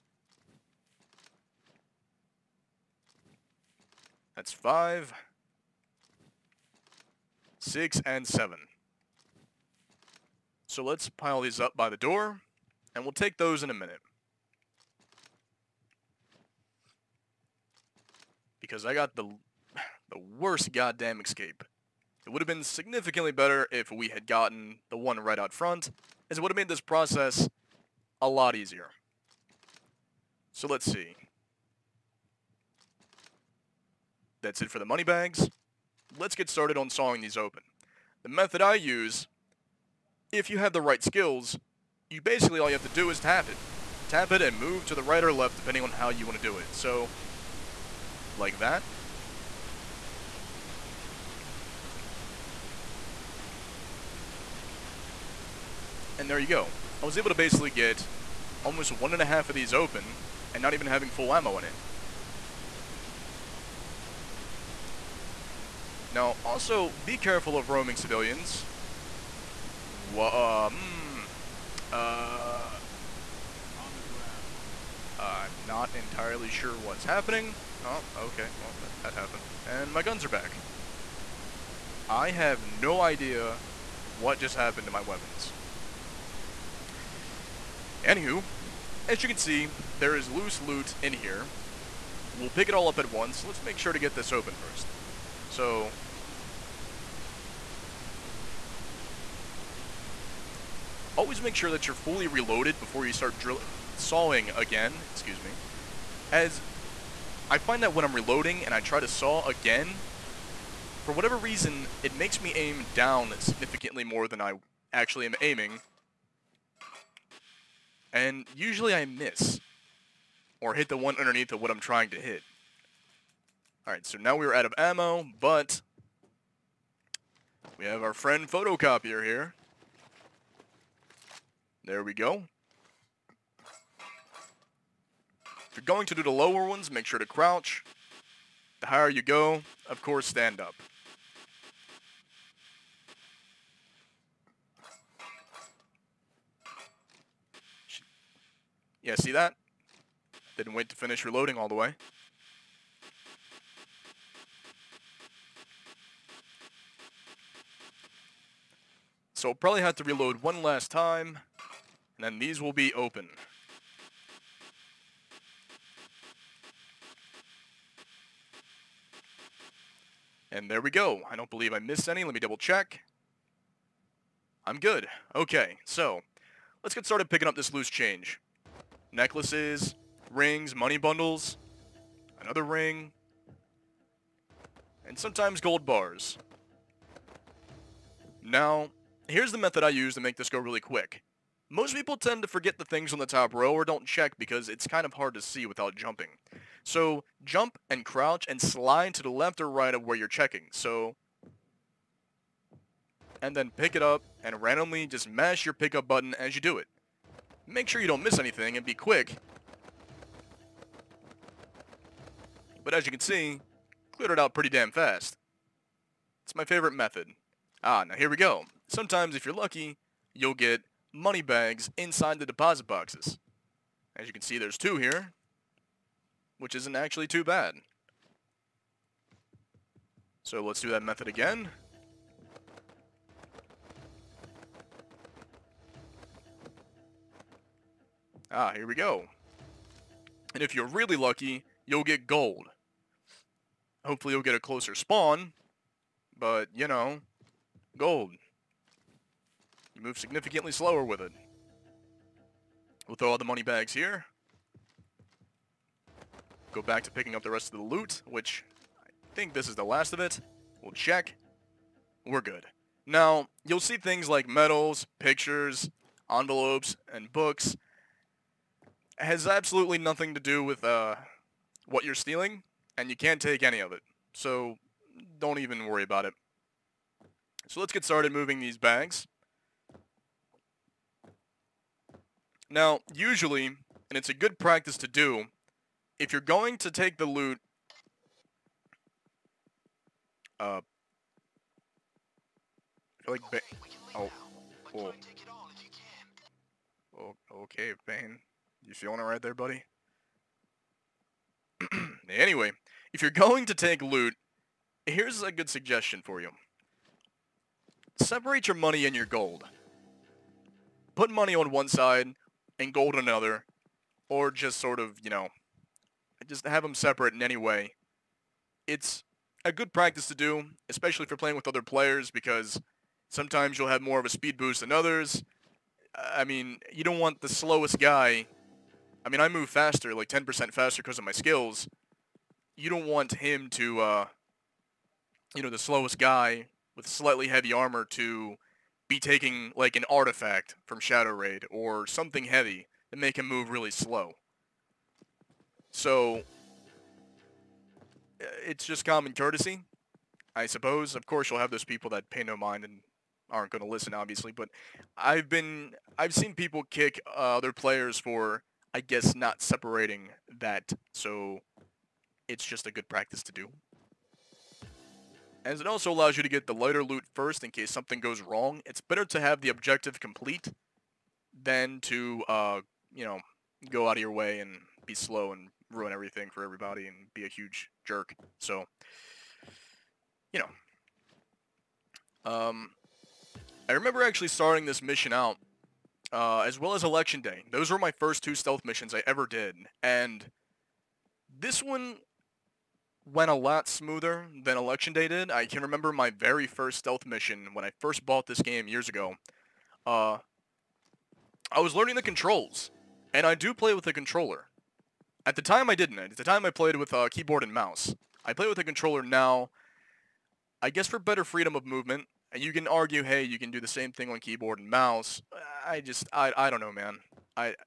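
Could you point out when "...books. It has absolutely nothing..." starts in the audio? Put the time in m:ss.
4:27.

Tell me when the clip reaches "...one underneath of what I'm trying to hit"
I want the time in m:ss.
2:00.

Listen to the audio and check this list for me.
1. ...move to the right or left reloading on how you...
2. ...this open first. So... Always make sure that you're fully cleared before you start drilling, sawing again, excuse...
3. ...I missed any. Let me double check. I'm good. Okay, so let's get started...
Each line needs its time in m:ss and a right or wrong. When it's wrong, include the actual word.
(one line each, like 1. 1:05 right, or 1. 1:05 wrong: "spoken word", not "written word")
1. 0:44 wrong: "depending", not "reloading"
2. 1:34 wrong: "reloaded", not "cleared"
3. 2:51 right.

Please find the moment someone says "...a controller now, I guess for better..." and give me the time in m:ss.
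6:48.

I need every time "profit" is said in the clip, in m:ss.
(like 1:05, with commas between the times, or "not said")
not said.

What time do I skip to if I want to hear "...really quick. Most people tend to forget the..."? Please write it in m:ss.
3:10.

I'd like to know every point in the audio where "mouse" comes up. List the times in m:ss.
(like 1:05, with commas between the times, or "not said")
6:47, 6:54.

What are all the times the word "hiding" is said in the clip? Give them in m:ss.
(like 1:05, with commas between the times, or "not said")
not said.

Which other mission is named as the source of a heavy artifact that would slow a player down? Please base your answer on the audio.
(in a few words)
Shadow Raid.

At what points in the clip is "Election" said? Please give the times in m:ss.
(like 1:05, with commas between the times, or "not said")
6:27, 6:34.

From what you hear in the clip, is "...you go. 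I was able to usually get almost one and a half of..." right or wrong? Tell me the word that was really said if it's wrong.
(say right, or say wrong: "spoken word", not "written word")
wrong: "basically", not "usually".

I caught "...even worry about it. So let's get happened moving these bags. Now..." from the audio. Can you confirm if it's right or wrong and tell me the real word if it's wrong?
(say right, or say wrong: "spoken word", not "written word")
wrong: "started", not "happened".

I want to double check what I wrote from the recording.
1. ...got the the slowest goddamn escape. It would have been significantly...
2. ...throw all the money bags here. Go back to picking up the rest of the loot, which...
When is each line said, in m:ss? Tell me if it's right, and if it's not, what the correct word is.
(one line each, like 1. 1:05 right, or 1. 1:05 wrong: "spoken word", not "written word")
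1. 0:18 wrong: "worst", not "slowest"
2. 4:13 right.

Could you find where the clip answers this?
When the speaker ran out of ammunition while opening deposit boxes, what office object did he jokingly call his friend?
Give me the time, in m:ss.
2:08.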